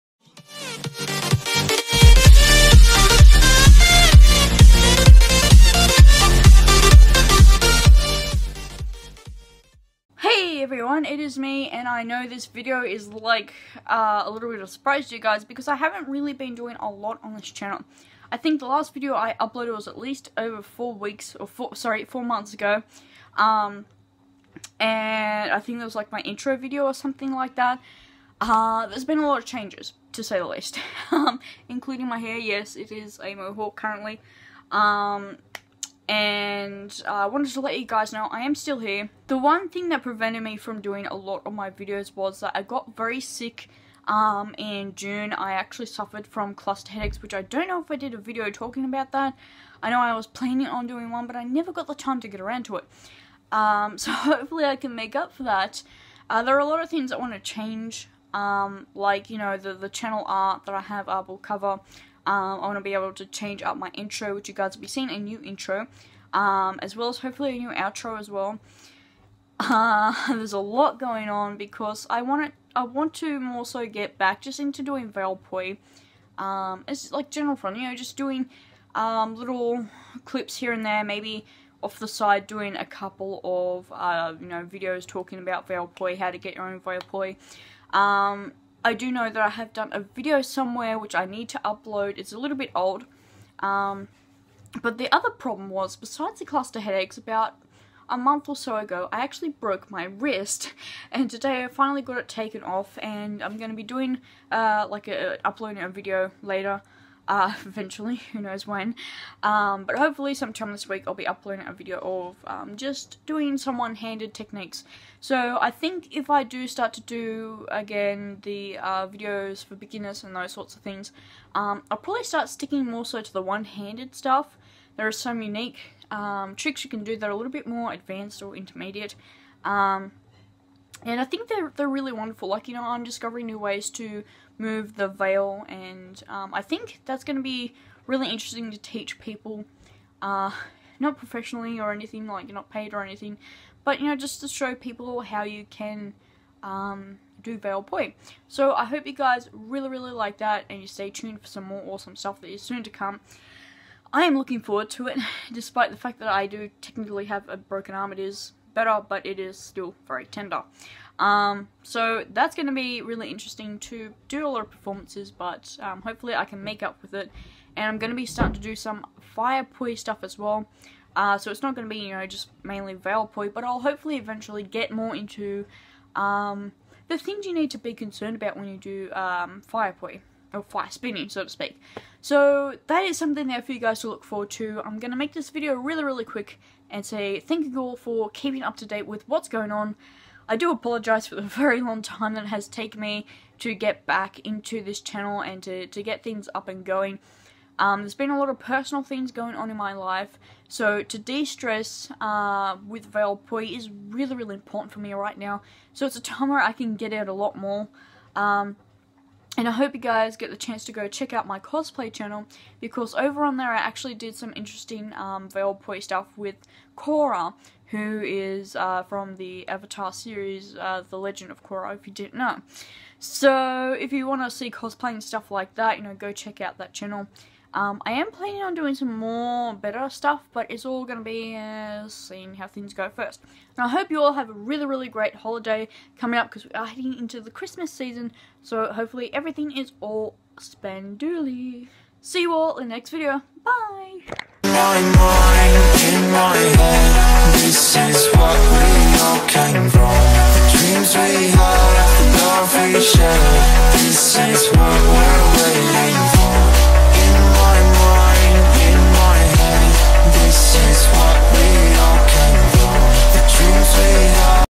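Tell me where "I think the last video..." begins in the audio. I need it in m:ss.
0:18.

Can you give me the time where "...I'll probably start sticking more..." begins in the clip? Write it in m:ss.
2:01.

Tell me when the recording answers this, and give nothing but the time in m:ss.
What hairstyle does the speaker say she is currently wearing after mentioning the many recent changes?
0:33.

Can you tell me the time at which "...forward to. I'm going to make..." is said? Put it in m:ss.
3:04.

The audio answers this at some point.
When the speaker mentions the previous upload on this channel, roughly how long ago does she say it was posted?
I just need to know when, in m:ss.
0:22.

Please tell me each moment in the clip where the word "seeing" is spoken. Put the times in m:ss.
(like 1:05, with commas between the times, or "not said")
1:04, 3:52.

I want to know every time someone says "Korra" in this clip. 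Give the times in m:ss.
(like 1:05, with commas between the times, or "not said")
3:36, 3:41.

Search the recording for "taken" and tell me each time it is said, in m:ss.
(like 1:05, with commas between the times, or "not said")
1:42, 3:12.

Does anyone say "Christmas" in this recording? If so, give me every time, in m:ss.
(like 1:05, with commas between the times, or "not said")
3:57.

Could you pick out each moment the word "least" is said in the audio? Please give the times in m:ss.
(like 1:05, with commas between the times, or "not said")
0:19, 0:30.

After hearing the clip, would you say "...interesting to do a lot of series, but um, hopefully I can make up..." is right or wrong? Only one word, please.
wrong.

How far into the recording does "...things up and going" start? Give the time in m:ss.
3:16.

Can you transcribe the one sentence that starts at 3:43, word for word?
So if you want to see cosplaying stuff like that, you know, go check out that channel.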